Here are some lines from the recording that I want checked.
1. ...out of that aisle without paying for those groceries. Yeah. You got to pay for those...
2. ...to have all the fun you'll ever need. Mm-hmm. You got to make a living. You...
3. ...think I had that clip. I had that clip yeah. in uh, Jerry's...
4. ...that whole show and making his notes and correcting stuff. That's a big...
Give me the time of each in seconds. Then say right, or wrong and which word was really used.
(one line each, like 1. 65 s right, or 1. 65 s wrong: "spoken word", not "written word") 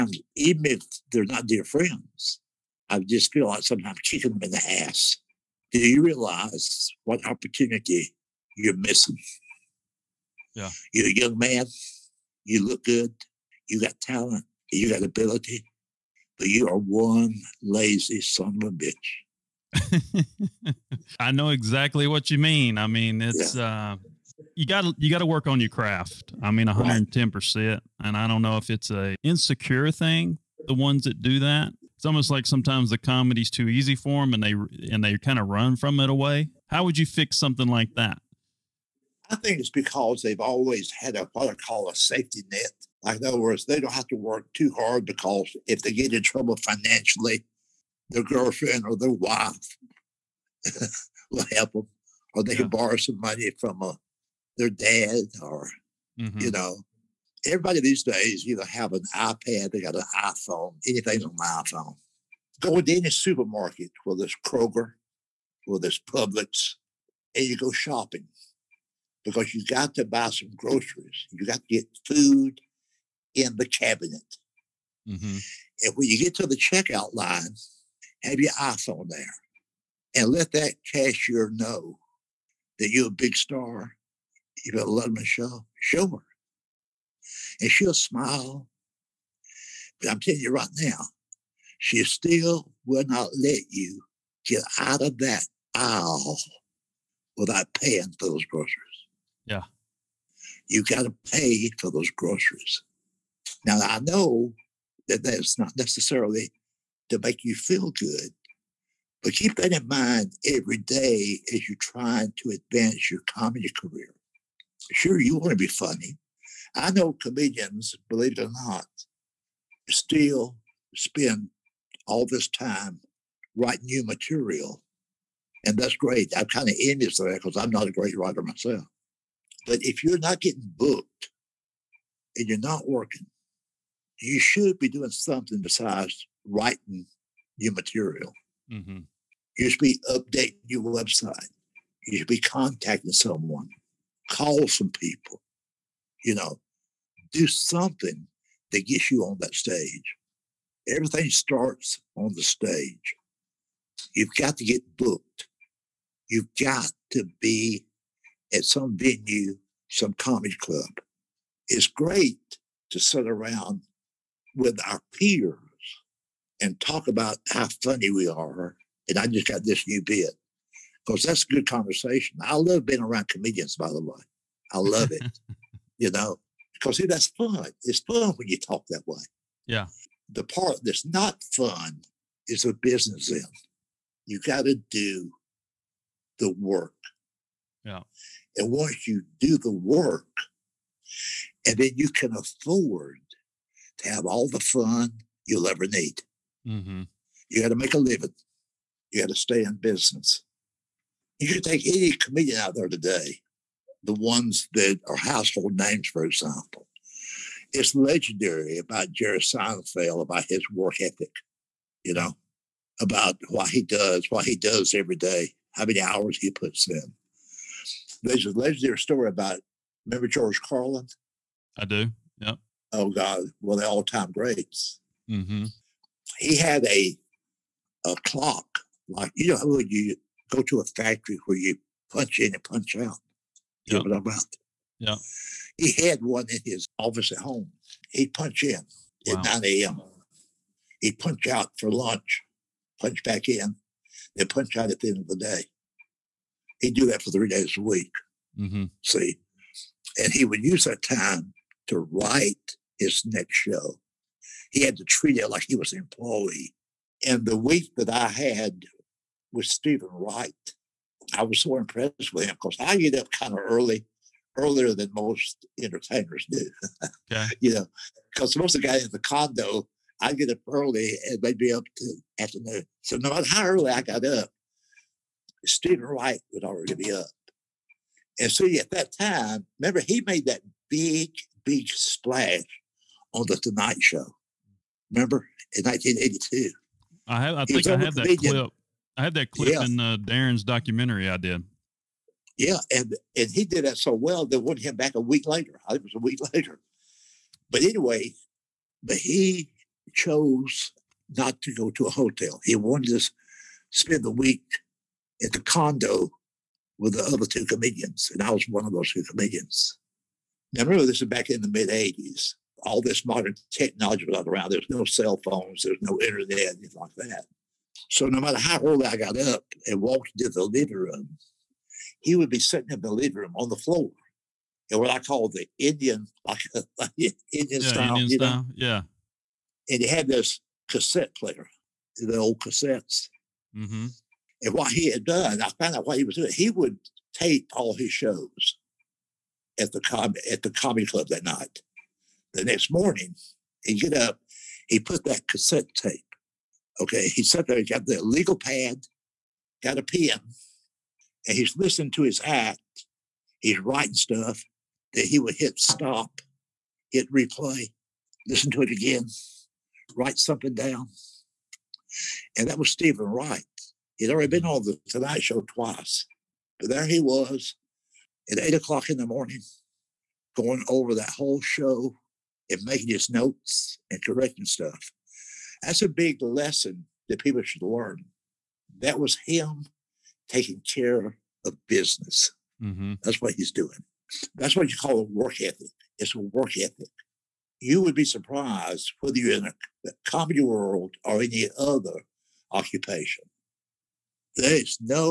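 1. 94 s right
2. 193 s right
3. 287 s wrong: "Darren", not "Jerry"
4. 371 s right.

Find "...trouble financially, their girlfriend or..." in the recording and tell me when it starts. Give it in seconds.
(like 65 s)
46 s.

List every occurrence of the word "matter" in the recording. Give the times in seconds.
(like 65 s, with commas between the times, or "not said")
273 s, 318 s.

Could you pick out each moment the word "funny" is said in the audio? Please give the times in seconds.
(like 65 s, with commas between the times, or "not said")
115 s, 167 s.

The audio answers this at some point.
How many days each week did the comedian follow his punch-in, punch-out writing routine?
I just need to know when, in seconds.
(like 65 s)
247 s.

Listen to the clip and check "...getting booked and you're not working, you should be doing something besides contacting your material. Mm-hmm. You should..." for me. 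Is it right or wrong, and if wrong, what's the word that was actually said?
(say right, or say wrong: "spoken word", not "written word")
wrong: "writing", not "contacting".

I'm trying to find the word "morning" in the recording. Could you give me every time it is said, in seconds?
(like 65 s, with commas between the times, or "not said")
342 s, 369 s.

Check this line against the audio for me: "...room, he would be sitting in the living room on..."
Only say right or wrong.
right.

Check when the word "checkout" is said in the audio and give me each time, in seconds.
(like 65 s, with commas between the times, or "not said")
76 s.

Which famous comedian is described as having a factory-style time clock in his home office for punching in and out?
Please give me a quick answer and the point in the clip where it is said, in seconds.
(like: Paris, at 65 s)
George Carlin, at 220 s.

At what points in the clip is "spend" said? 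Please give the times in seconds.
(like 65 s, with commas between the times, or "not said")
120 s, 303 s.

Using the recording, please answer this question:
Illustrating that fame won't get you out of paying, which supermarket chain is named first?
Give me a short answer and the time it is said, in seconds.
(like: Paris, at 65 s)
Kroger, at 64 s.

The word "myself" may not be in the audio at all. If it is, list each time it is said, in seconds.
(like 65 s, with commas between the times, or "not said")
128 s.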